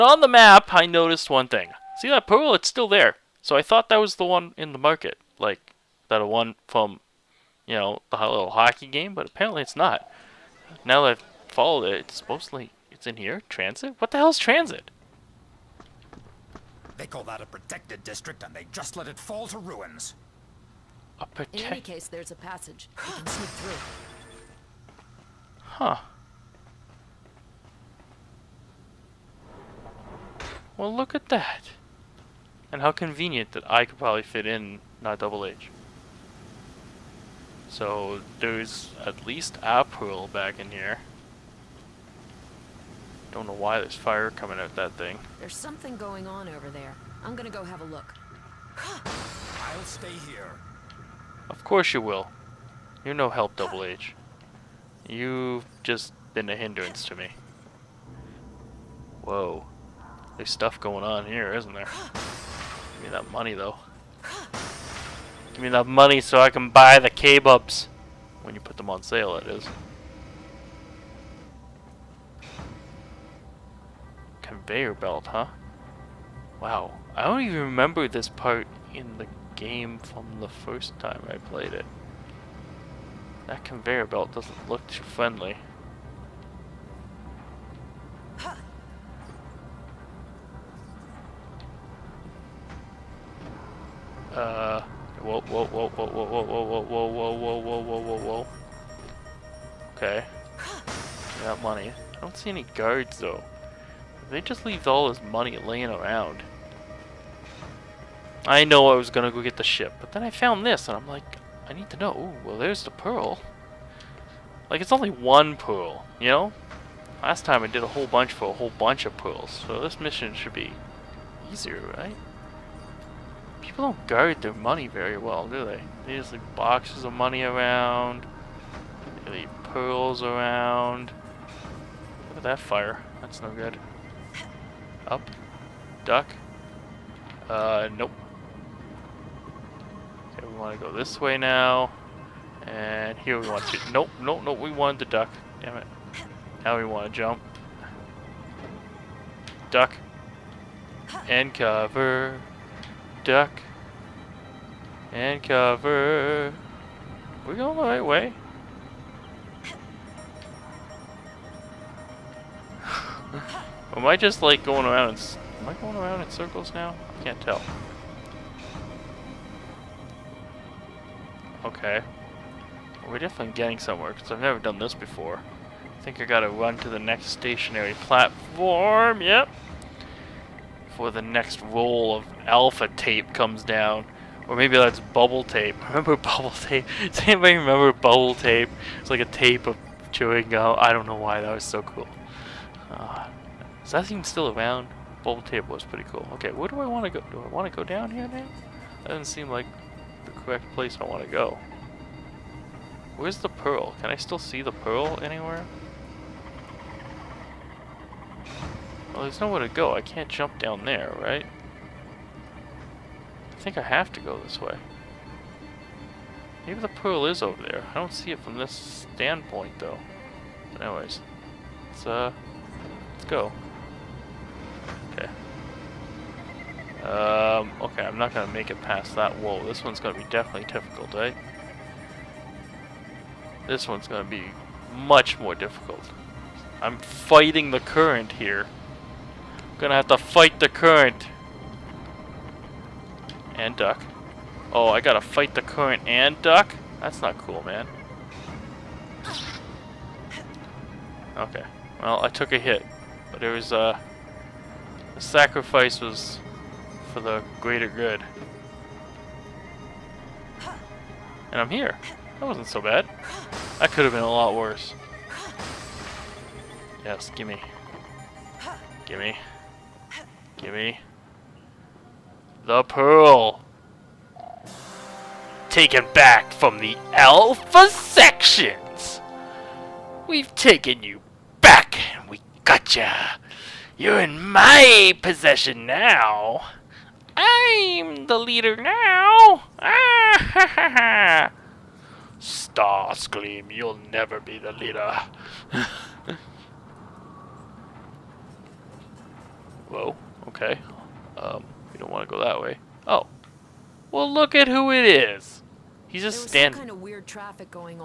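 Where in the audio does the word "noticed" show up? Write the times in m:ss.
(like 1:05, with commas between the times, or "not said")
0:00.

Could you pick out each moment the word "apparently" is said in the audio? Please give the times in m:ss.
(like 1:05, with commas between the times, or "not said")
0:09.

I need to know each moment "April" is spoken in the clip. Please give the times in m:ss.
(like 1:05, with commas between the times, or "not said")
0:39.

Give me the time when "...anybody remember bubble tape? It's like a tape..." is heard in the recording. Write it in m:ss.
3:07.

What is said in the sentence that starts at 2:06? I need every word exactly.
They just leave boxes of money around.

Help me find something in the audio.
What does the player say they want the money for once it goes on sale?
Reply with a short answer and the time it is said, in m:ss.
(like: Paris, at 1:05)
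K-Bups, at 1:07.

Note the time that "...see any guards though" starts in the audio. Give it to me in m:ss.
1:42.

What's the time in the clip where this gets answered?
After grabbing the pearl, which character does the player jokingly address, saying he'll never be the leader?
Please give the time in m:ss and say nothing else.
4:52.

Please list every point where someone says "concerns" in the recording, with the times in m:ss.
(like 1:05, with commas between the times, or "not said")
not said.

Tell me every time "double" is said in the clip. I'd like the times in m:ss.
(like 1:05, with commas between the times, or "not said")
0:35, 0:53.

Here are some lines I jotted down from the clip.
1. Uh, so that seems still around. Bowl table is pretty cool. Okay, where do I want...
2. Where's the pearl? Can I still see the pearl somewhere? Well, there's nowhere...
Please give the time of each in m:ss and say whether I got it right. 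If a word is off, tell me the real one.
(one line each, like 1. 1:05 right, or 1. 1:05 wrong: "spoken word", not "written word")
1. 3:12 right
2. 3:23 wrong: "anywhere", not "somewhere".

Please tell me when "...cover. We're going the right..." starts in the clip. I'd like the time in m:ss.
2:35.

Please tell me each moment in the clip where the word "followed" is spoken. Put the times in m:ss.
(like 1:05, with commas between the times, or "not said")
0:11.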